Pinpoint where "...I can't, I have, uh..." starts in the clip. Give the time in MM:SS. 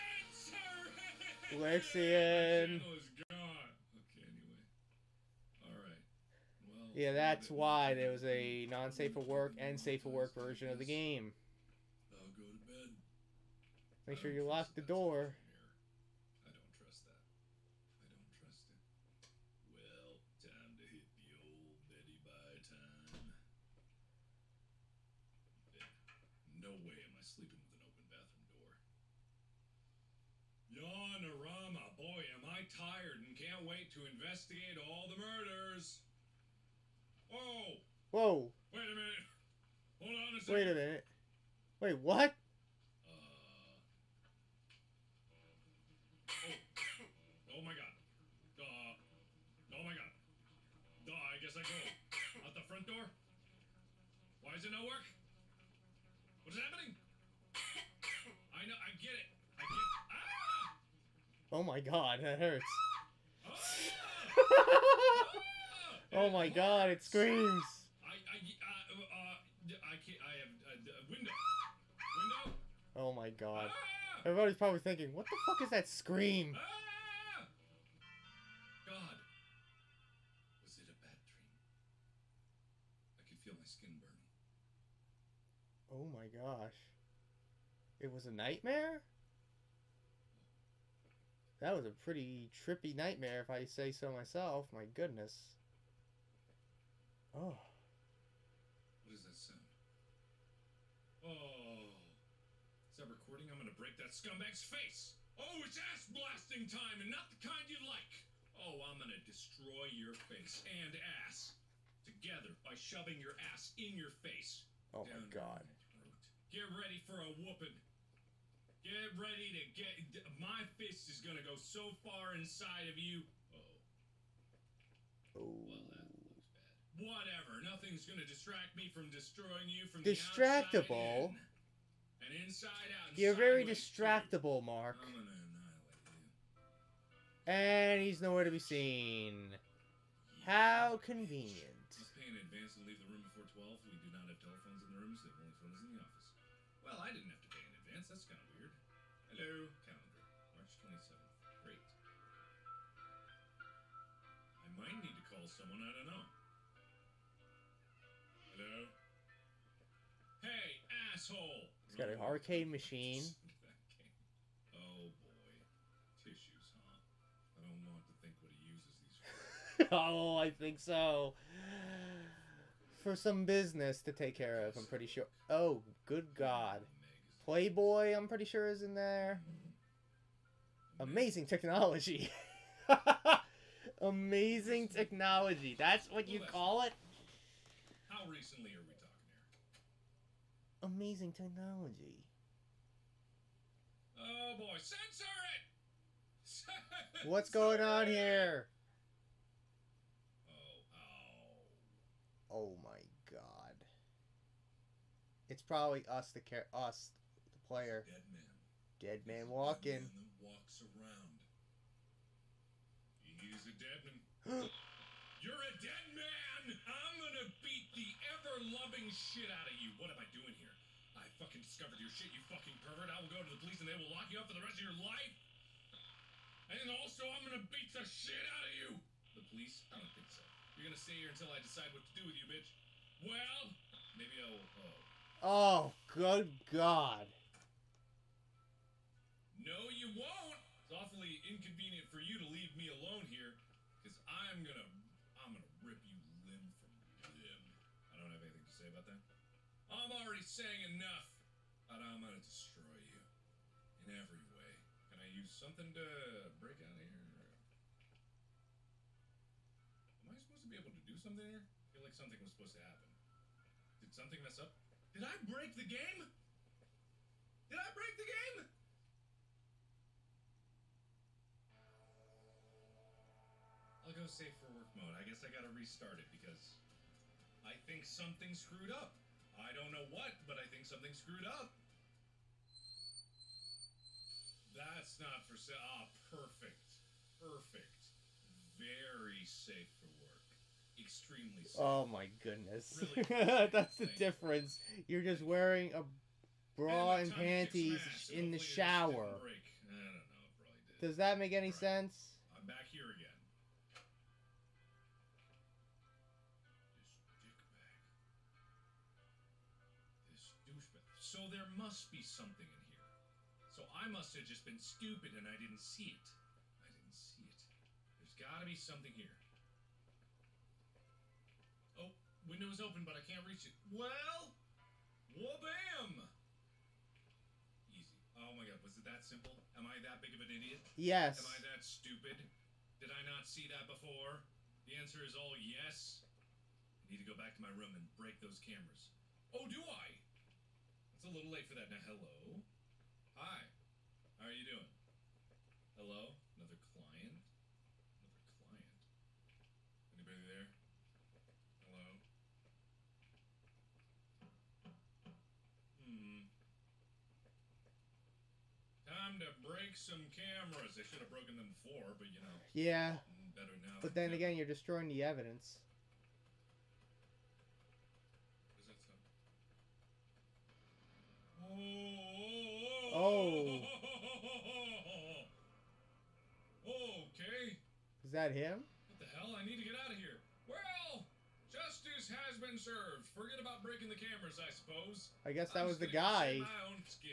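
01:09.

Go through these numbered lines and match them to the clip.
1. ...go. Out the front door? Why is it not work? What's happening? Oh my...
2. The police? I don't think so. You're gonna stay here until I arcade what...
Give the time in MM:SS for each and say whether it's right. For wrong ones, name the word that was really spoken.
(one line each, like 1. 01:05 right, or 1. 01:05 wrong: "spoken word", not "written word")
1. 00:51 right
2. 03:49 wrong: "decide", not "arcade".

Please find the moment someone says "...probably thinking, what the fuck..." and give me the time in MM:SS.
01:14.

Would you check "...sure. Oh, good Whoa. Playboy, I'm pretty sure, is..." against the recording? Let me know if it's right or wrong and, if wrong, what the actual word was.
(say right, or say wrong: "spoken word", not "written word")
wrong: "God", not "Whoa".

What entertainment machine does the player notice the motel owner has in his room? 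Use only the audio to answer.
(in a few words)
An arcade machine.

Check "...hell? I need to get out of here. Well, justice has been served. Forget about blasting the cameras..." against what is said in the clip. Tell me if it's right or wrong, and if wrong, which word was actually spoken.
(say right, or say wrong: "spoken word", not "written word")
wrong: "breaking", not "blasting".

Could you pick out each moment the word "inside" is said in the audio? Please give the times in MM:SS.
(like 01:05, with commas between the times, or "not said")
02:02, 02:12.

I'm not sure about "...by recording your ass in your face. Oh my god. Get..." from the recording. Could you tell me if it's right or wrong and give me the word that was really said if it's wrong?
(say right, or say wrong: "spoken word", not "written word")
wrong: "shoving", not "recording".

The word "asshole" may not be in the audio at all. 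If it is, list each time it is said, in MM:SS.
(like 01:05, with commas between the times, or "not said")
02:41.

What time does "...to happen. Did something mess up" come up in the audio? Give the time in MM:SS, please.
04:22.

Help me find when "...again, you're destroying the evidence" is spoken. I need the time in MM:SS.
06:04.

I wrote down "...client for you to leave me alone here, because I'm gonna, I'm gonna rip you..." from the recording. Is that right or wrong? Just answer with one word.
wrong.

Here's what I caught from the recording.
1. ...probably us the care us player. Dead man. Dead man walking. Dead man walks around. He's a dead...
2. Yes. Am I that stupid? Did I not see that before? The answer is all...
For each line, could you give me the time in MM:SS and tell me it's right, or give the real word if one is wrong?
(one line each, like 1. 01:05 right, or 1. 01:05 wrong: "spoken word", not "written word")
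1. 03:25 right
2. 05:30 right.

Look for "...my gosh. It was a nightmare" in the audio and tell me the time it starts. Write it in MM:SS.
01:26.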